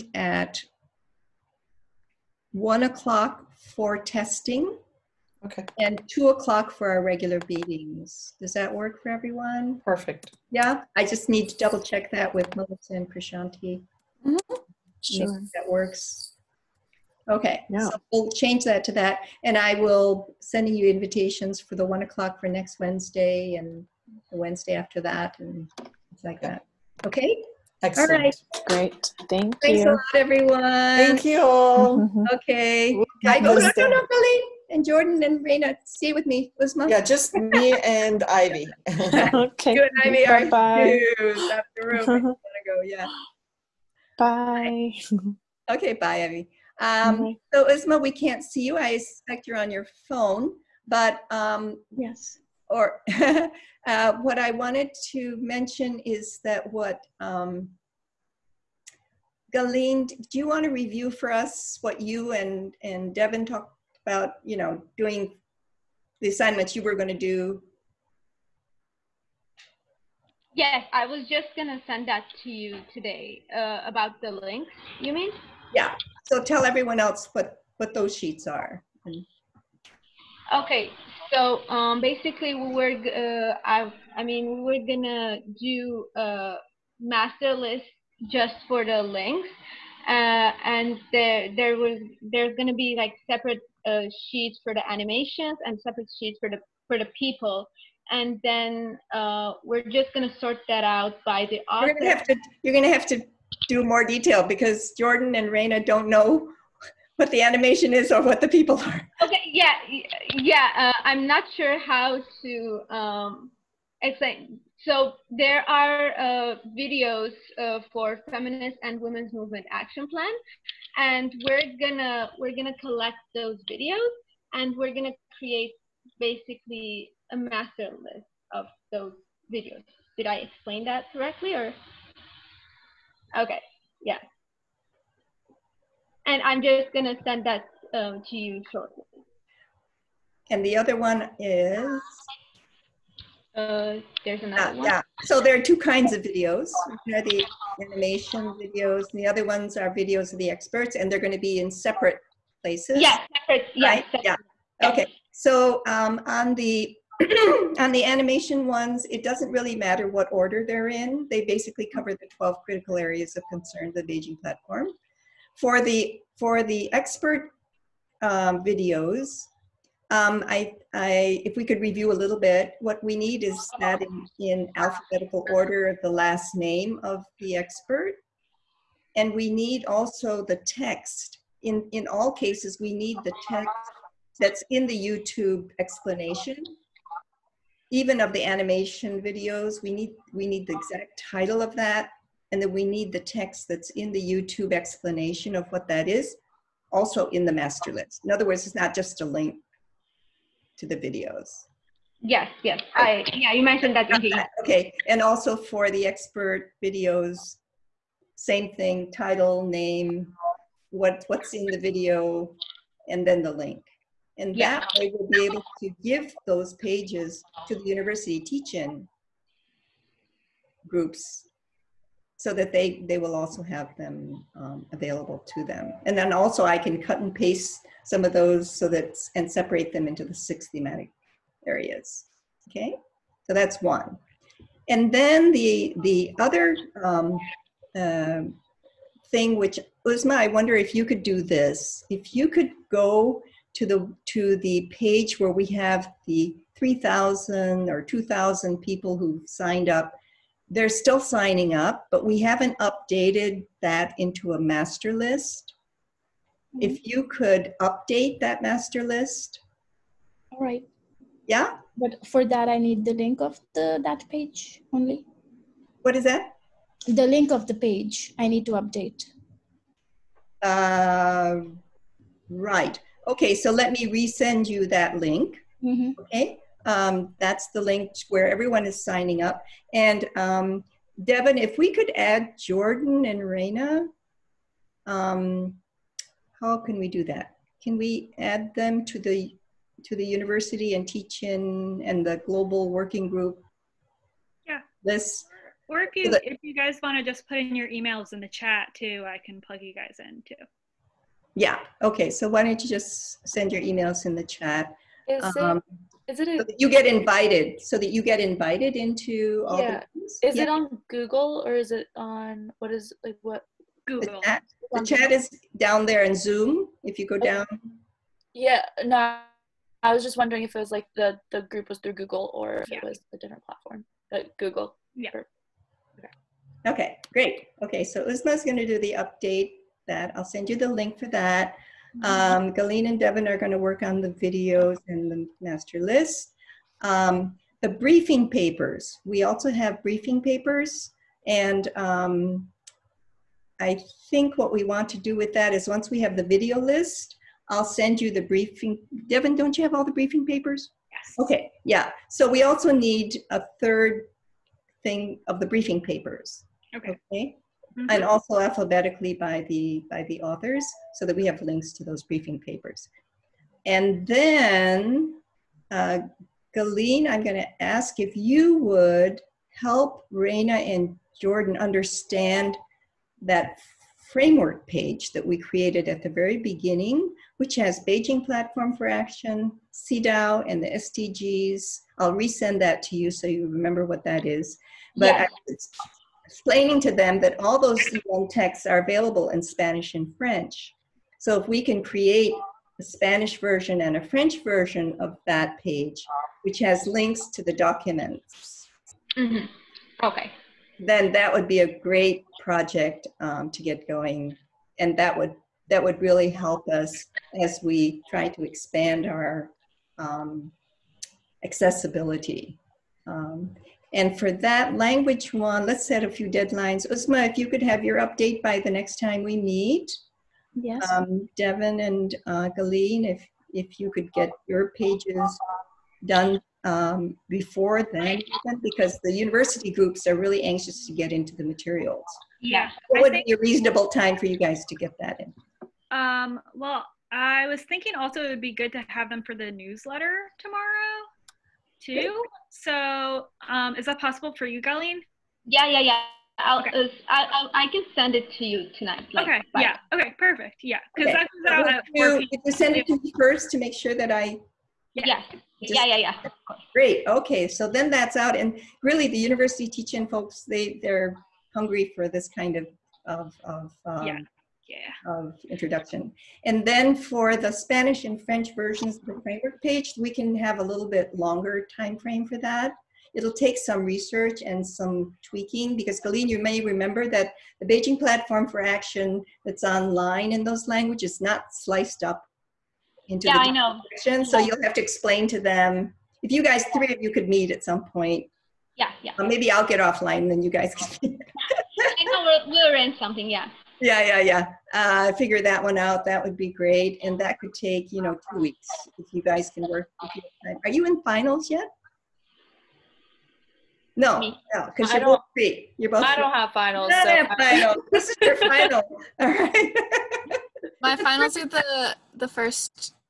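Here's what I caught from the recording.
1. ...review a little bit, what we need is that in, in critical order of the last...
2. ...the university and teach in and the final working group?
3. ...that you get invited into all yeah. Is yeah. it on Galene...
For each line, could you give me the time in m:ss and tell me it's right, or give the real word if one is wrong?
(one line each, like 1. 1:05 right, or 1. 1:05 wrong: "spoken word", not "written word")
1. 2:51 wrong: "alphabetical", not "critical"
2. 4:50 wrong: "global", not "final"
3. 5:07 wrong: "Google", not "Galene".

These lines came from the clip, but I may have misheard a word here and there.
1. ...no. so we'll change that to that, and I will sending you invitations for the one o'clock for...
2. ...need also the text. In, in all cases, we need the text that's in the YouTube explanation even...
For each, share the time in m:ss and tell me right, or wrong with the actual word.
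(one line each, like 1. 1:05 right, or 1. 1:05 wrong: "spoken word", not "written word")
1. 0:17 right
2. 2:59 right.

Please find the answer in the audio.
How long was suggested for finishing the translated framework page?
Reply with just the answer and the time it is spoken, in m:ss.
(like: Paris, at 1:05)
2 weeks, at 8:18.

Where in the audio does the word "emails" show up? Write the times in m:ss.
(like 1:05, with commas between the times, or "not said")
4:57, 5:03.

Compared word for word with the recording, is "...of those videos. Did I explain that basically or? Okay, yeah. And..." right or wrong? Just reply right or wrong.
wrong.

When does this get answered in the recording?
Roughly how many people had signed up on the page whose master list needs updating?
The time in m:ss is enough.
4:06.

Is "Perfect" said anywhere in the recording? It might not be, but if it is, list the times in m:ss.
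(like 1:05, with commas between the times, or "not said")
0:09, 7:30.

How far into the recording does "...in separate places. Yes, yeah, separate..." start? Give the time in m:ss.
2:31.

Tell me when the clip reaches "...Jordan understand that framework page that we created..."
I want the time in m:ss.
6:11.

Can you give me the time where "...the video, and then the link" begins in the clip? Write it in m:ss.
3:31.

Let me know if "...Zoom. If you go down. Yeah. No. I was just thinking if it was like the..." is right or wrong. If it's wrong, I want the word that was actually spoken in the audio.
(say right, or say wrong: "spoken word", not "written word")
wrong: "wondering", not "thinking".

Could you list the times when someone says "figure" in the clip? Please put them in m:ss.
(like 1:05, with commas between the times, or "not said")
8:15.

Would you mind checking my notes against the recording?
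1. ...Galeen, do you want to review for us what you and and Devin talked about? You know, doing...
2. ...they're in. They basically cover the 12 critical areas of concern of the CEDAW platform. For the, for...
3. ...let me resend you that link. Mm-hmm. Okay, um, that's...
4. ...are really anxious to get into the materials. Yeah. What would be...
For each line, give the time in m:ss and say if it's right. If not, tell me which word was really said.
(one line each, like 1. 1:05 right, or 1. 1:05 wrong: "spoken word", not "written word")
1. 0:59 right
2. 2:40 wrong: "Beijing", not "CEDAW"
3. 4:33 right
4. 7:10 right.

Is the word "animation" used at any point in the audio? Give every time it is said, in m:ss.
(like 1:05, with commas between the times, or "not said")
1:34, 1:47, 2:27, 2:38, 3:08.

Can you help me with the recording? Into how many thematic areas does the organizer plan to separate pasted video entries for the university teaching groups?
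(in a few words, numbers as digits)
6.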